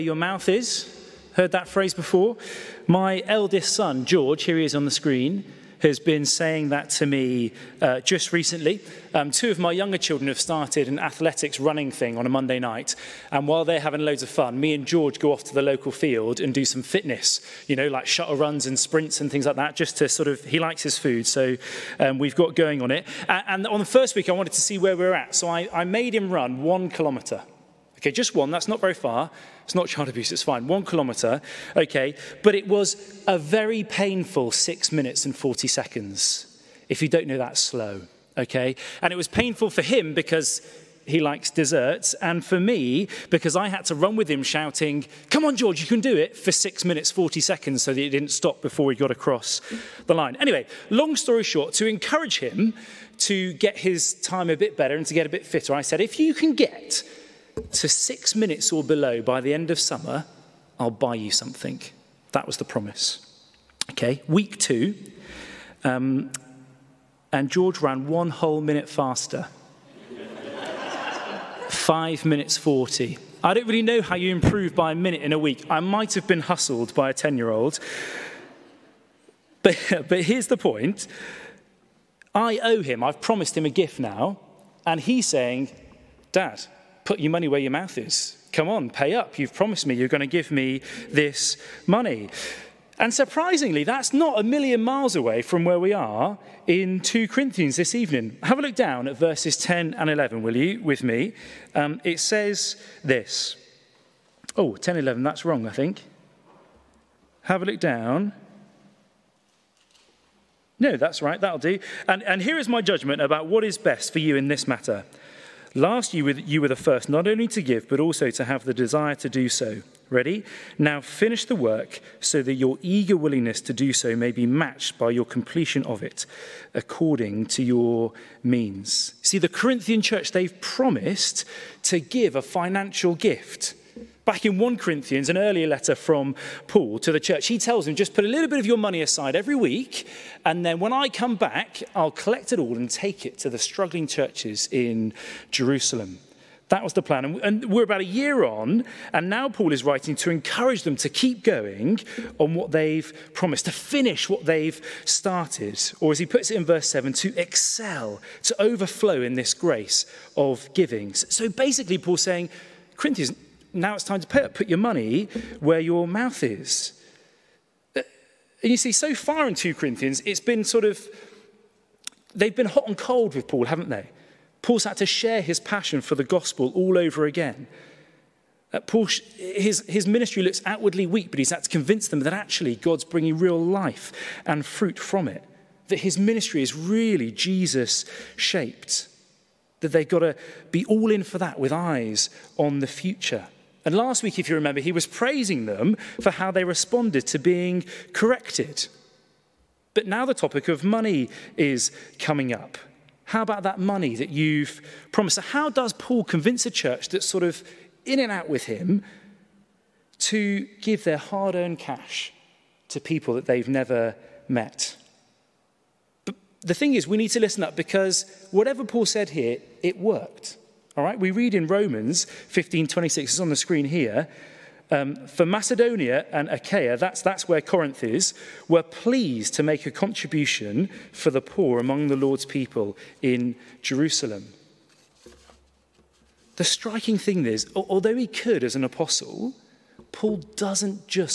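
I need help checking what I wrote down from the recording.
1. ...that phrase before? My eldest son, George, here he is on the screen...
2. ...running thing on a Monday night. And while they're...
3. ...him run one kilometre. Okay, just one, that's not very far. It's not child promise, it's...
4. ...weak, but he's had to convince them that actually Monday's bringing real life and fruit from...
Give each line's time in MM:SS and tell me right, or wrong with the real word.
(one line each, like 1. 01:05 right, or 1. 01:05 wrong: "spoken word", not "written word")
1. 00:01 right
2. 00:11 right
3. 00:26 wrong: "abuse", not "promise"
4. 03:01 wrong: "God", not "Monday".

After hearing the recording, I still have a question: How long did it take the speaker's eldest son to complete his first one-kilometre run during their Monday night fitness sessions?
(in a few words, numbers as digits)
6 minutes 40 seconds.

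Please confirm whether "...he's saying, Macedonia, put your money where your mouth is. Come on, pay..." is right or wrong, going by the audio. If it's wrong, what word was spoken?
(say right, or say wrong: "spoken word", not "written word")
wrong: "Dad", not "Macedonia".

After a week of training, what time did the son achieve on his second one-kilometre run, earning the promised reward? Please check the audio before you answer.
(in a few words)
5 minutes 40.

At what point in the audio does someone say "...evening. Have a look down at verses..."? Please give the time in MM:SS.
01:37.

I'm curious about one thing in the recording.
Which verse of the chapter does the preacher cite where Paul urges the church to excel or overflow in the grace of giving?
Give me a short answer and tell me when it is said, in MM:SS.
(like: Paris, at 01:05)
verse 7, at 02:36.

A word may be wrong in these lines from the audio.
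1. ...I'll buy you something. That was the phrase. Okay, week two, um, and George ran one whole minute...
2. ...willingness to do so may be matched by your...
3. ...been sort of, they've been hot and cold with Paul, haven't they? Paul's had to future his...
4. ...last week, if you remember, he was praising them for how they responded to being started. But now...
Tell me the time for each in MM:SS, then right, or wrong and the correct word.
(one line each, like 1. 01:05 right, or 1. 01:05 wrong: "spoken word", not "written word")
1. 01:00 wrong: "promise", not "phrase"
2. 02:03 right
3. 02:50 wrong: "share", not "future"
4. 03:13 wrong: "corrected", not "started".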